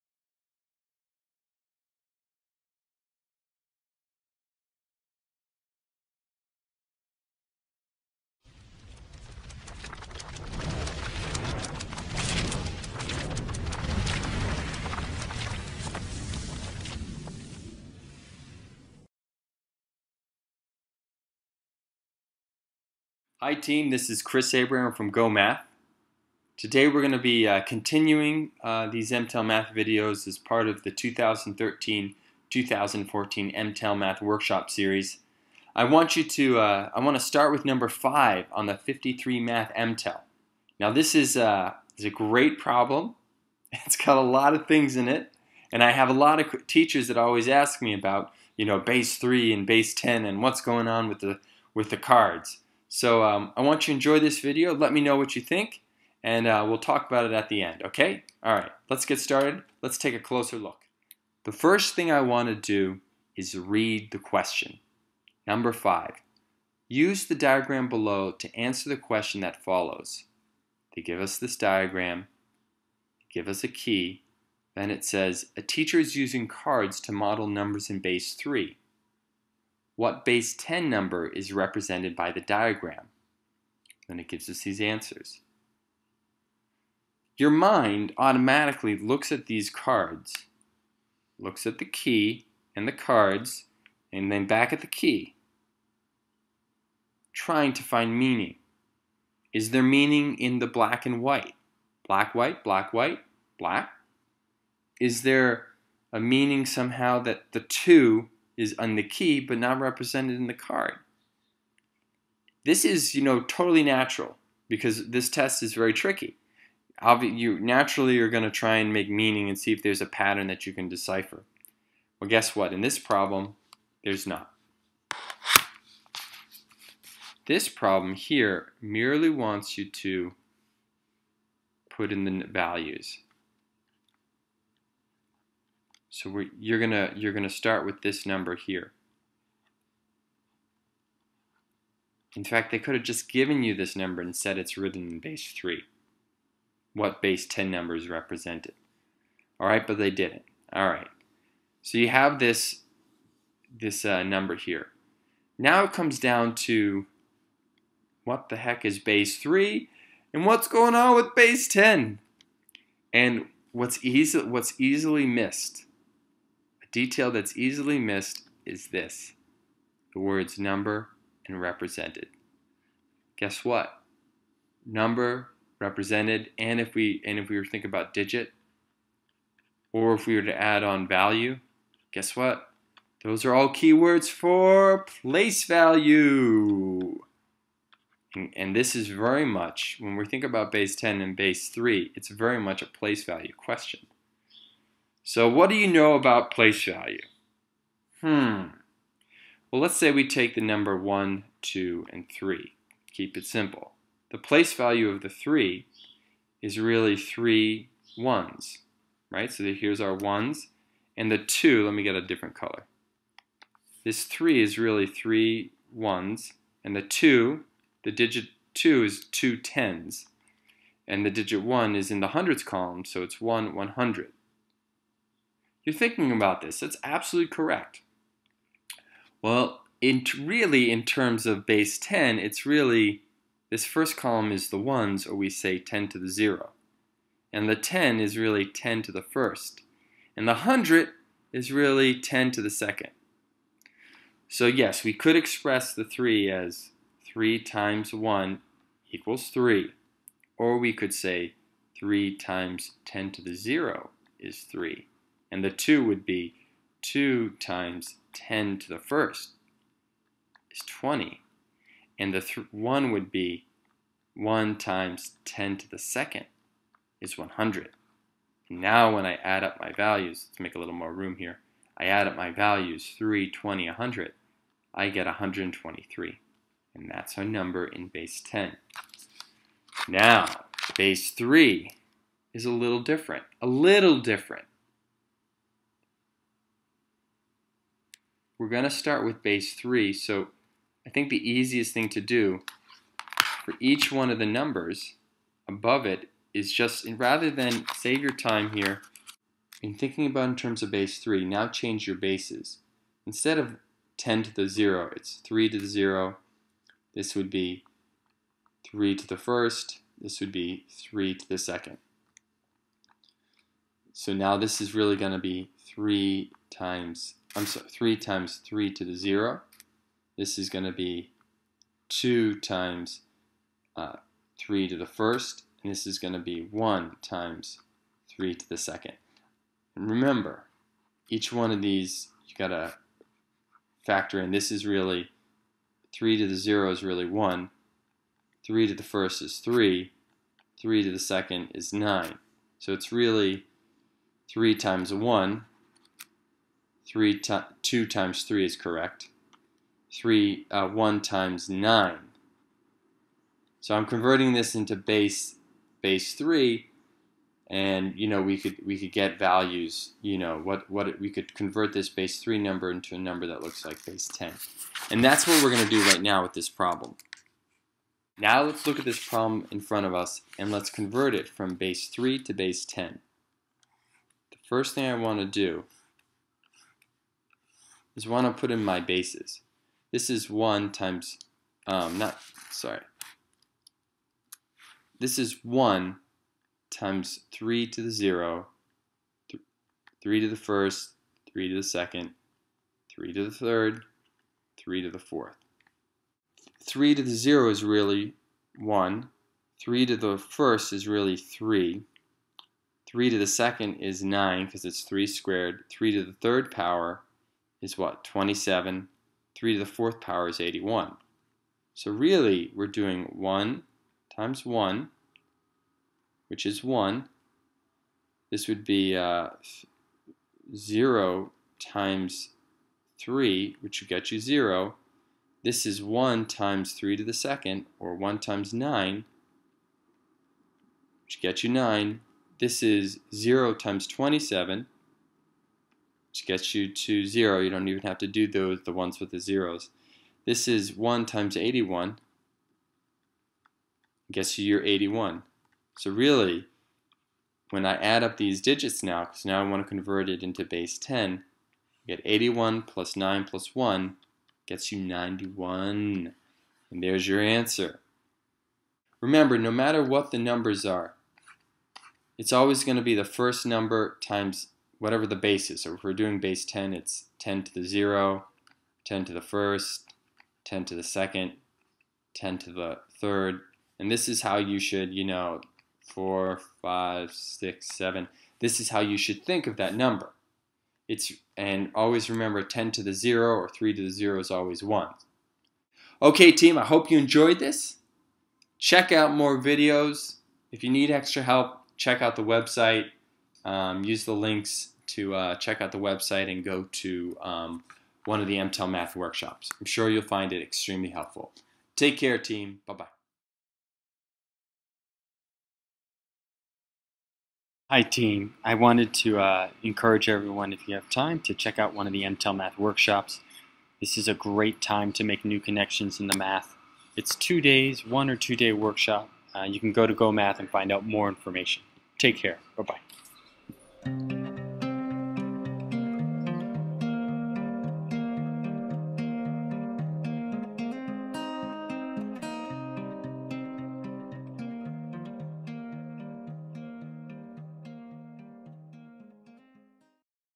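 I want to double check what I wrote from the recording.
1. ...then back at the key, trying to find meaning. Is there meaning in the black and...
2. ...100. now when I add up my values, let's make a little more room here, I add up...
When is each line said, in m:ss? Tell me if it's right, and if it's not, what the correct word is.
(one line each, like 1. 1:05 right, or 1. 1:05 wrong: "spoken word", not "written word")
1. 1:34 right
2. 4:27 right.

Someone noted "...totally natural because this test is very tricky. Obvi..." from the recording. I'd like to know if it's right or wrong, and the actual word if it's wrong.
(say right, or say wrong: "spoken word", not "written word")
right.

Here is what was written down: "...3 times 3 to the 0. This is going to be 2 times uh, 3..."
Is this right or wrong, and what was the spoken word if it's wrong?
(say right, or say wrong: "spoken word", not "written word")
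right.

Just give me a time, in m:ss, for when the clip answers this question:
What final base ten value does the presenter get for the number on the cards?
7:34.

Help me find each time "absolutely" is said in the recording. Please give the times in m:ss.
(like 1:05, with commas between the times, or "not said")
3:47.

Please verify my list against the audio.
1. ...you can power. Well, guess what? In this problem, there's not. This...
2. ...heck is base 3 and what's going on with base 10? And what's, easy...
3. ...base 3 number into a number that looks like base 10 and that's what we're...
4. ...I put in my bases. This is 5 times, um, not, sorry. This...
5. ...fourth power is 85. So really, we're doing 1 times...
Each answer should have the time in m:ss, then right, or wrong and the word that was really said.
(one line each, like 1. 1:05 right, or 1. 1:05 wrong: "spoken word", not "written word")
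1. 2:00 wrong: "decipher", not "power"
2. 2:38 right
3. 6:02 right
4. 6:18 wrong: "1", not "5"
5. 6:49 wrong: "81", not "85".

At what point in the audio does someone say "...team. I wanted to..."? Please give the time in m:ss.
8:28.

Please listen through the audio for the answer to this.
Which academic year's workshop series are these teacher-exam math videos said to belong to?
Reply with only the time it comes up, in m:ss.
0:30.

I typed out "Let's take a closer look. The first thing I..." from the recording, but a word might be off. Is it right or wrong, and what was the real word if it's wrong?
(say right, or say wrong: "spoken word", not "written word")
right.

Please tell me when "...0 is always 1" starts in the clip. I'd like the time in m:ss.
8:04.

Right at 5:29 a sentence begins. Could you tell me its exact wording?
And remember, each one of these, you got to factor in.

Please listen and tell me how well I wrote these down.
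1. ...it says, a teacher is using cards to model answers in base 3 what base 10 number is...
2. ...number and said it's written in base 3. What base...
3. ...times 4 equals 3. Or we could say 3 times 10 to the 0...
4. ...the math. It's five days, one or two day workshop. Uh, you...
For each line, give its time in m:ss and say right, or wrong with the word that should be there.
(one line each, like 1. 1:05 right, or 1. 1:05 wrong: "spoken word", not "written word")
1. 1:14 wrong: "numbers", not "answers"
2. 2:23 right
3. 4:07 wrong: "1", not "4"
4. 8:36 wrong: "two", not "five".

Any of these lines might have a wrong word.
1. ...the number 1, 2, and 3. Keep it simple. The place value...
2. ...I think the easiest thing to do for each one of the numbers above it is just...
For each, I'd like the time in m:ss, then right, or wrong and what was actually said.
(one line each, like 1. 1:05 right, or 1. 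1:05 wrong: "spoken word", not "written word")
1. 3:20 right
2. 4:51 right.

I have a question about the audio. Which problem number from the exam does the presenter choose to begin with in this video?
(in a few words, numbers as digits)
5.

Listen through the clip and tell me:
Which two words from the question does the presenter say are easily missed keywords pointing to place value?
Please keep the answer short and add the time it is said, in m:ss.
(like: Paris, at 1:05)
number and represented, at 2:50.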